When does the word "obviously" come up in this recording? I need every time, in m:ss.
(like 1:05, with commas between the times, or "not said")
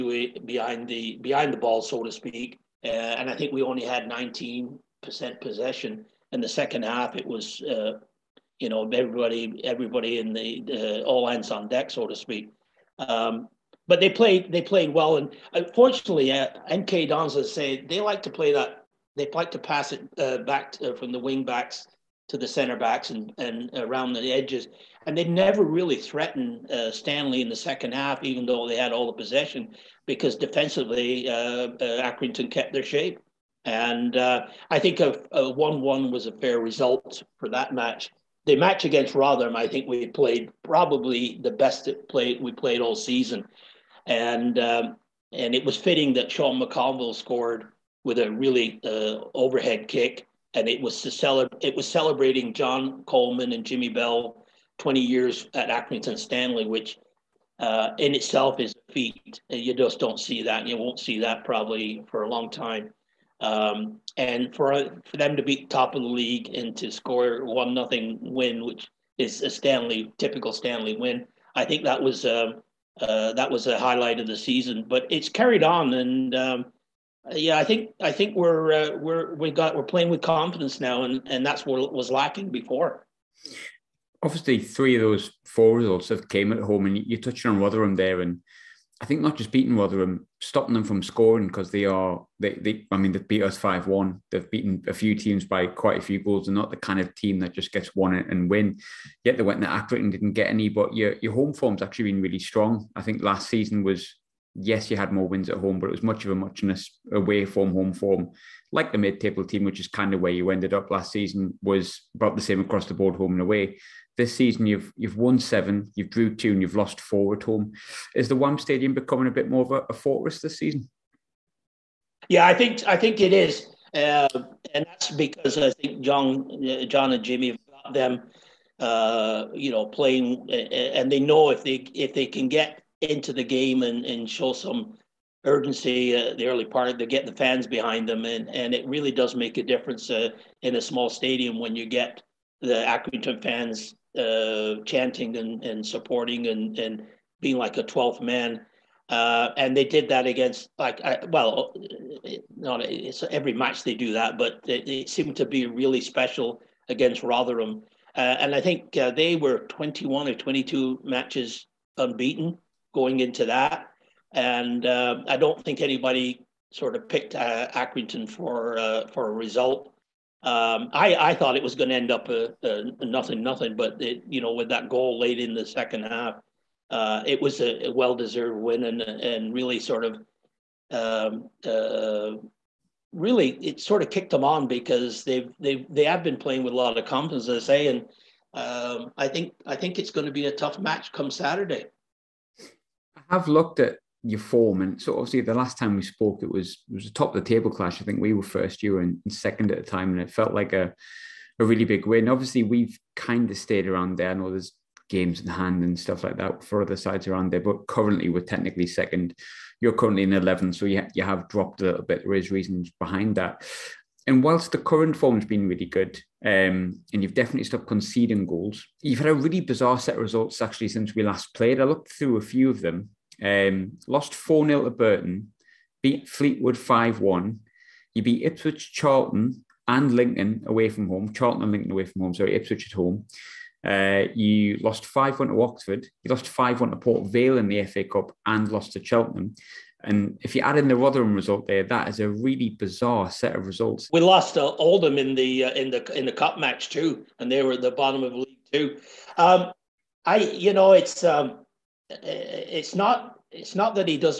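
1:24, 3:15, 3:22.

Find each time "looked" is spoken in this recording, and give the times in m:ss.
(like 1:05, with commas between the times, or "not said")
3:13, 3:41.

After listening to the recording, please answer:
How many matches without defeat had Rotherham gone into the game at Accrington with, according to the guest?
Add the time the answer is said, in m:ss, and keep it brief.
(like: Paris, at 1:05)
21 or 22, at 2:39.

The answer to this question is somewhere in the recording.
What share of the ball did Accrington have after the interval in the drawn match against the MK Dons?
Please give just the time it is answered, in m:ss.
0:04.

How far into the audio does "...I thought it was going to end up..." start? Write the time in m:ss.
2:51.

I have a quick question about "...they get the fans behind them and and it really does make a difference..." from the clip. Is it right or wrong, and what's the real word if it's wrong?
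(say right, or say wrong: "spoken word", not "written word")
right.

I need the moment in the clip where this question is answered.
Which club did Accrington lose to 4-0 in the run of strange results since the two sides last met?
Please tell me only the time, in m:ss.
3:44.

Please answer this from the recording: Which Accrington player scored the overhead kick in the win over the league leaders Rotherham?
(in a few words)
Sean McConville.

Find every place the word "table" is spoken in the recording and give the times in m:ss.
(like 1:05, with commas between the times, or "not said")
1:49, 3:17.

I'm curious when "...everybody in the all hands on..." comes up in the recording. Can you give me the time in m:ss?
0:09.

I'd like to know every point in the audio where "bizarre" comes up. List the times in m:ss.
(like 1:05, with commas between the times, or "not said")
3:39, 4:02.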